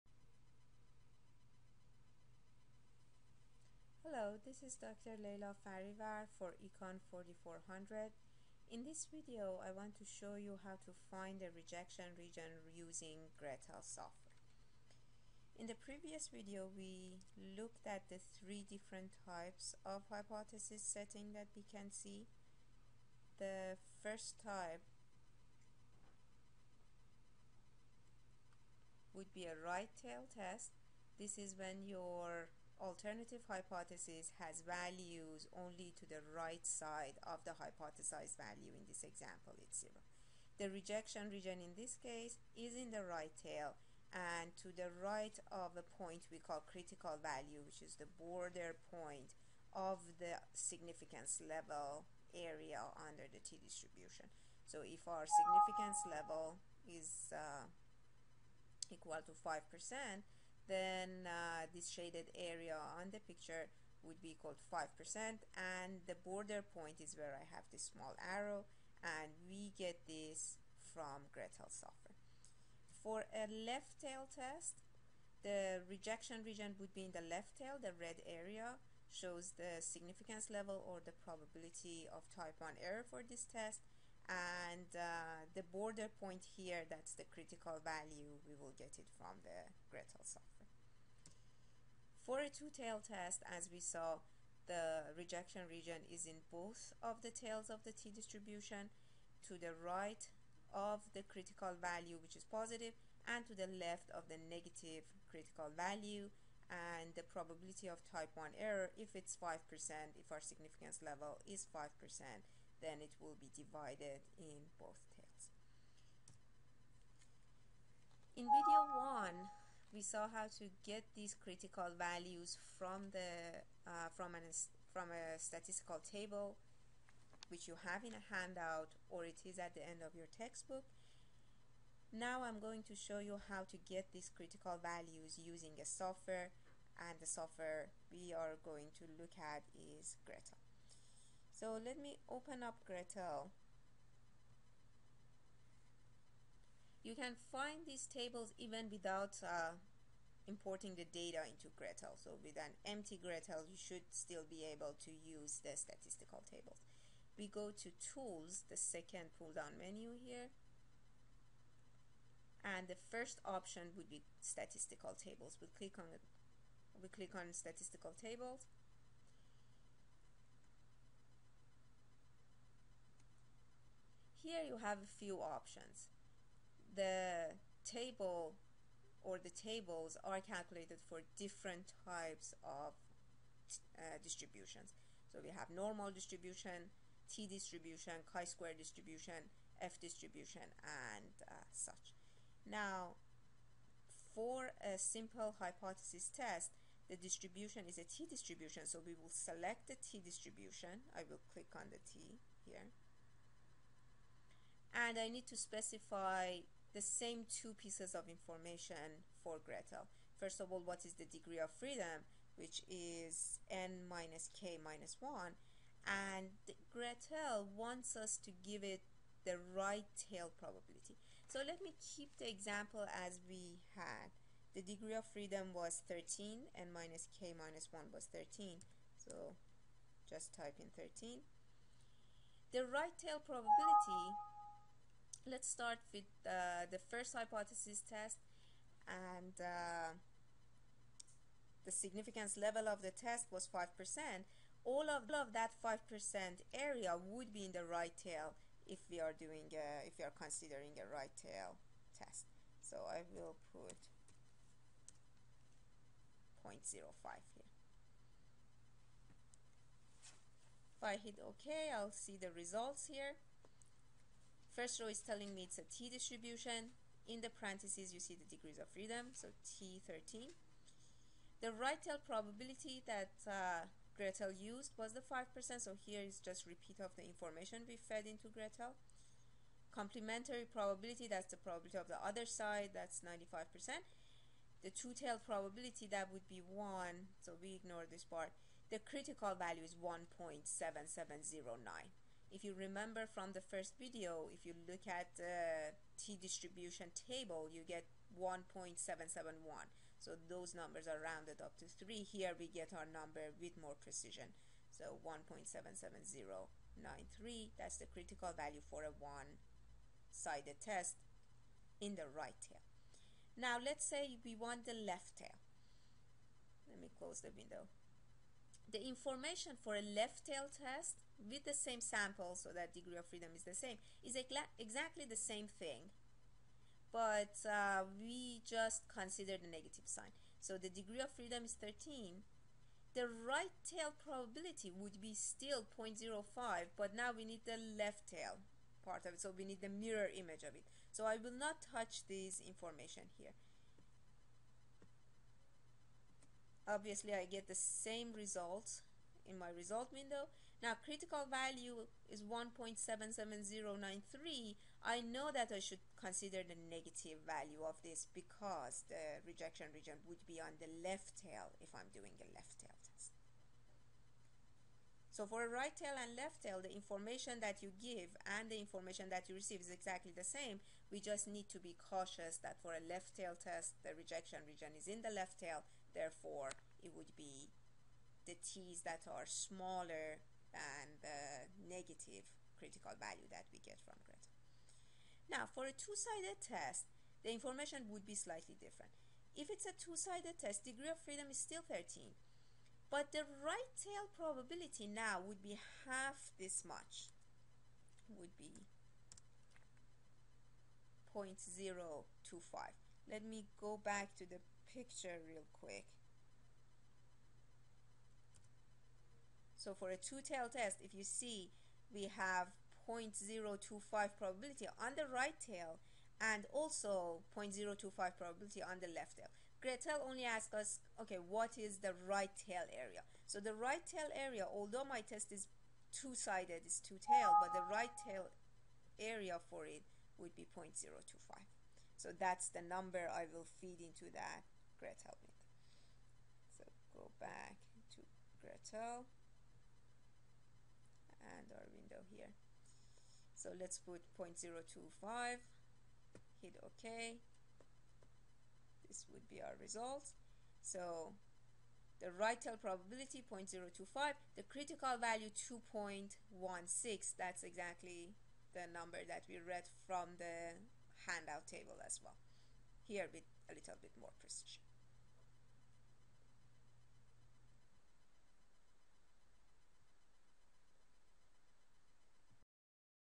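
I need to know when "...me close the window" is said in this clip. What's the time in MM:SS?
05:16.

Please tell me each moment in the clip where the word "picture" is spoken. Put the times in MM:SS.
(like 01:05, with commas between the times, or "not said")
01:03, 06:44.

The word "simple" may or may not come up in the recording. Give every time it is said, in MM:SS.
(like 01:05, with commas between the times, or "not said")
03:14.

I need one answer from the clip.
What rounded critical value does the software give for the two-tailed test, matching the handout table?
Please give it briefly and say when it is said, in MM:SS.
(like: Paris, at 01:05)
2.16, at 07:35.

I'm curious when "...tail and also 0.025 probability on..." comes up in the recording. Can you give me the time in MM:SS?
06:55.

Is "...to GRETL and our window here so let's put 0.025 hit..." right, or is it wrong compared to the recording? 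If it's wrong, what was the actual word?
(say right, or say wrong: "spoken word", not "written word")
right.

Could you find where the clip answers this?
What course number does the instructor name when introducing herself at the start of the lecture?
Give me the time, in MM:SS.
00:06.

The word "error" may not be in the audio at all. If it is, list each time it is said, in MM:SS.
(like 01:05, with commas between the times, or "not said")
01:22, 01:48.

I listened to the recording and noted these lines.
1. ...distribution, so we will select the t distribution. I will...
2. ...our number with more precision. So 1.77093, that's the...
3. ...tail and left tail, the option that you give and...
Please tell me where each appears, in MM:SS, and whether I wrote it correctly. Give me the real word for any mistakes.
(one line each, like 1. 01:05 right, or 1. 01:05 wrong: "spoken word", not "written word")
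1. 03:18 right
2. 05:02 right
3. 06:05 wrong: "information", not "option".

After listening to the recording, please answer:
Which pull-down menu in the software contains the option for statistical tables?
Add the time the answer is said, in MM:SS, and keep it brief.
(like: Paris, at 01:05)
Tools, at 02:38.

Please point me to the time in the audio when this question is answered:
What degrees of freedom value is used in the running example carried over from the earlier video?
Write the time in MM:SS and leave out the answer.
03:44.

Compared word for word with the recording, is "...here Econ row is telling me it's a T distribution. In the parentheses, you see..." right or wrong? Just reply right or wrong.
wrong.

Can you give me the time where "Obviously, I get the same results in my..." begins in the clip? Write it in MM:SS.
05:46.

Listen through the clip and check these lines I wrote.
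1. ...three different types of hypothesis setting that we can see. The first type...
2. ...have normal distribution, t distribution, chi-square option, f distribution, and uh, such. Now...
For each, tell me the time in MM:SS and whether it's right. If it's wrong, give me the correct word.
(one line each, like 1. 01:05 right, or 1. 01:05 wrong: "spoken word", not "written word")
1. 00:18 right
2. 03:05 wrong: "distribution", not "option".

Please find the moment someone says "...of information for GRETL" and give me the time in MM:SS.
03:28.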